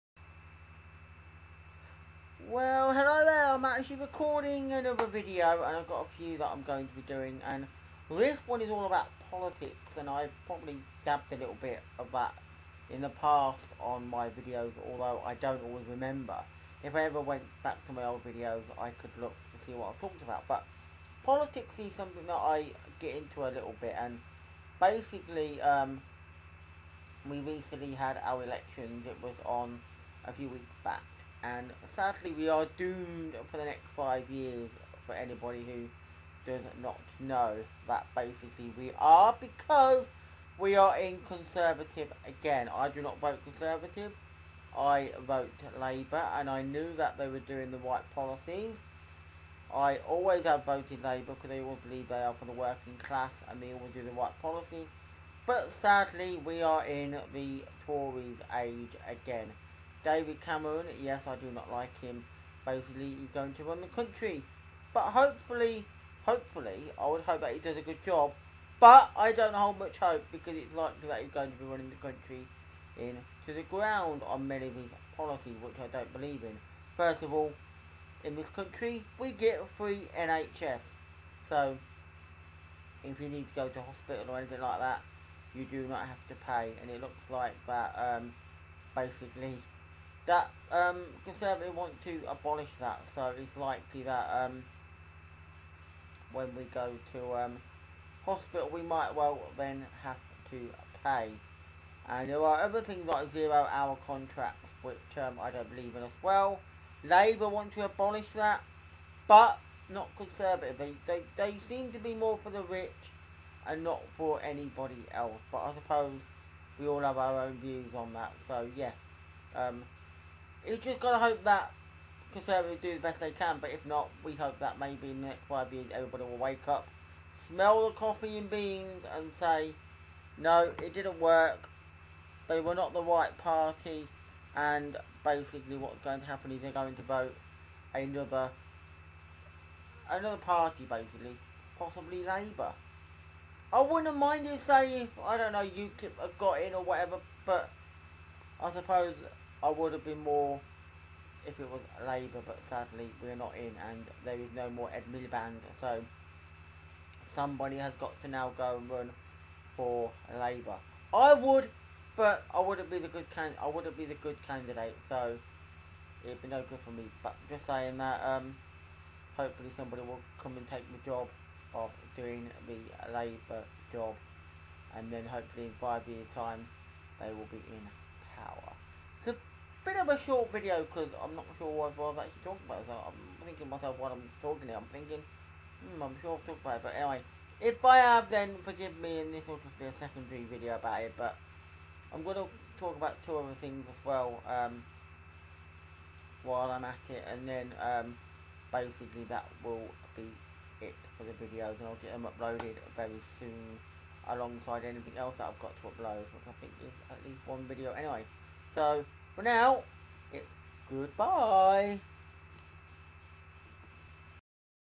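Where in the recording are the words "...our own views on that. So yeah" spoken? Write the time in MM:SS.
01:57.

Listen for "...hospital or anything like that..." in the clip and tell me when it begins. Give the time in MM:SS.
01:23.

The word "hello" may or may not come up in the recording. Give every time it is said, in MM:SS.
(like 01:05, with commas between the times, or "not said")
00:02.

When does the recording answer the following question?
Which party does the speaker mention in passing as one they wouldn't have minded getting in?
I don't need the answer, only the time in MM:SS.
02:25.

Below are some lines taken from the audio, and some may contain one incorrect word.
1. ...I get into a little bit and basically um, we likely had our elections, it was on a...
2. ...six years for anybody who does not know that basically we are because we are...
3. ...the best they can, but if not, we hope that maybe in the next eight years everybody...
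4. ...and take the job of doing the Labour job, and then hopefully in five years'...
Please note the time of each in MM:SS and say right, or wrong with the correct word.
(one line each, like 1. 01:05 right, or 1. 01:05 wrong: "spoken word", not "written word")
1. 00:22 wrong: "recently", not "likely"
2. 00:33 wrong: "five", not "six"
3. 02:02 wrong: "five", not "eight"
4. 02:50 right.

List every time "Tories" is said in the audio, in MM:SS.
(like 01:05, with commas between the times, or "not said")
00:57.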